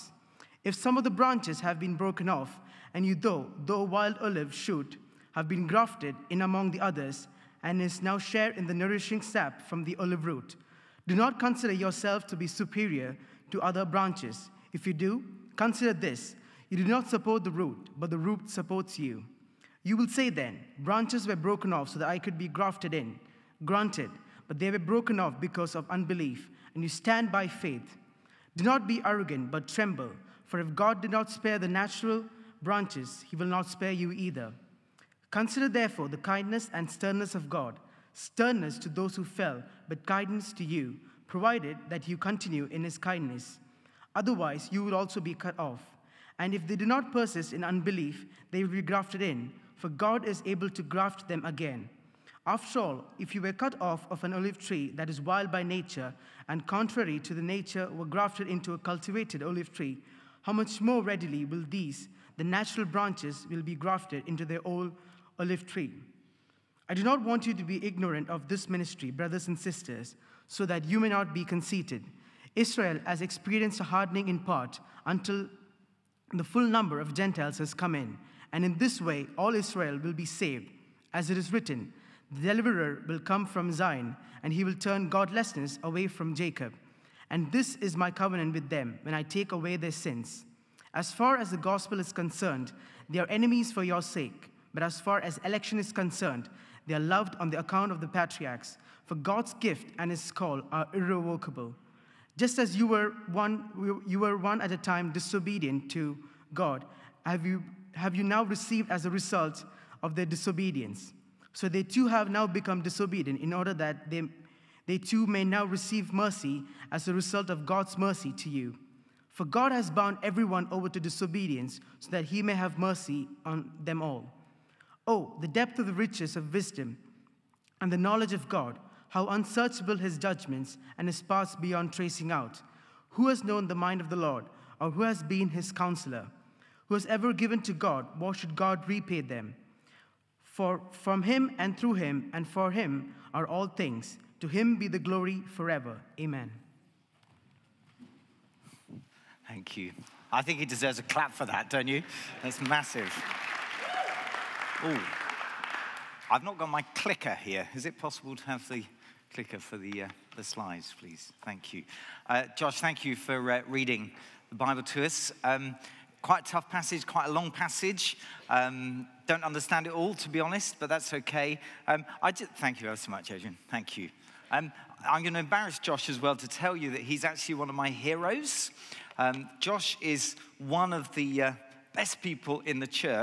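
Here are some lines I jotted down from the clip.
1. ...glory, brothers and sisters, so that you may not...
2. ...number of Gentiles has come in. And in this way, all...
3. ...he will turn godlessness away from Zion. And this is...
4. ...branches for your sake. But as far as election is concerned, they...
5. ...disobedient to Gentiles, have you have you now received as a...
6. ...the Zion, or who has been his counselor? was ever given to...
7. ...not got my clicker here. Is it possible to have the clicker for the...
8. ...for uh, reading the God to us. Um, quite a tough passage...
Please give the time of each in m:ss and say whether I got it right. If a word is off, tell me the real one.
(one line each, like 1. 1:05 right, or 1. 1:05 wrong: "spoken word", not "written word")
1. 1:08 wrong: "ministry", not "glory"
2. 1:16 right
3. 1:24 wrong: "Jacob", not "Zion"
4. 1:33 wrong: "enemies", not "branches"
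5. 1:45 wrong: "God", not "Gentiles"
6. 2:14 wrong: "Lord", not "Zion"
7. 2:36 right
8. 2:43 wrong: "Bible", not "God".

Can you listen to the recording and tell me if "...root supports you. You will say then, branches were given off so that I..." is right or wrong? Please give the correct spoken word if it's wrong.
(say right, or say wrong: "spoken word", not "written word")
wrong: "broken", not "given".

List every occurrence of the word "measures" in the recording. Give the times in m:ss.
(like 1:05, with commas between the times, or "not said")
not said.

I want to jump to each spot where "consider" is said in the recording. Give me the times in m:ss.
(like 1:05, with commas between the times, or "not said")
0:11, 0:15, 0:35.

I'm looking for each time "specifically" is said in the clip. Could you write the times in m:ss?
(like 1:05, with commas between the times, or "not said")
not said.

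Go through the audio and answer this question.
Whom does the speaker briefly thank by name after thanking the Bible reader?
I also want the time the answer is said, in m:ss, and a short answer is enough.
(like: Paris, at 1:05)
Adrian, at 2:53.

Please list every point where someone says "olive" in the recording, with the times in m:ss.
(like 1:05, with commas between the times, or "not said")
0:04, 0:09, 0:54, 0:59, 1:05.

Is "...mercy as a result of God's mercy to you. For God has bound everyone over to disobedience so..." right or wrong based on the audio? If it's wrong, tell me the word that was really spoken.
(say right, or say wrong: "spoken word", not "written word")
right.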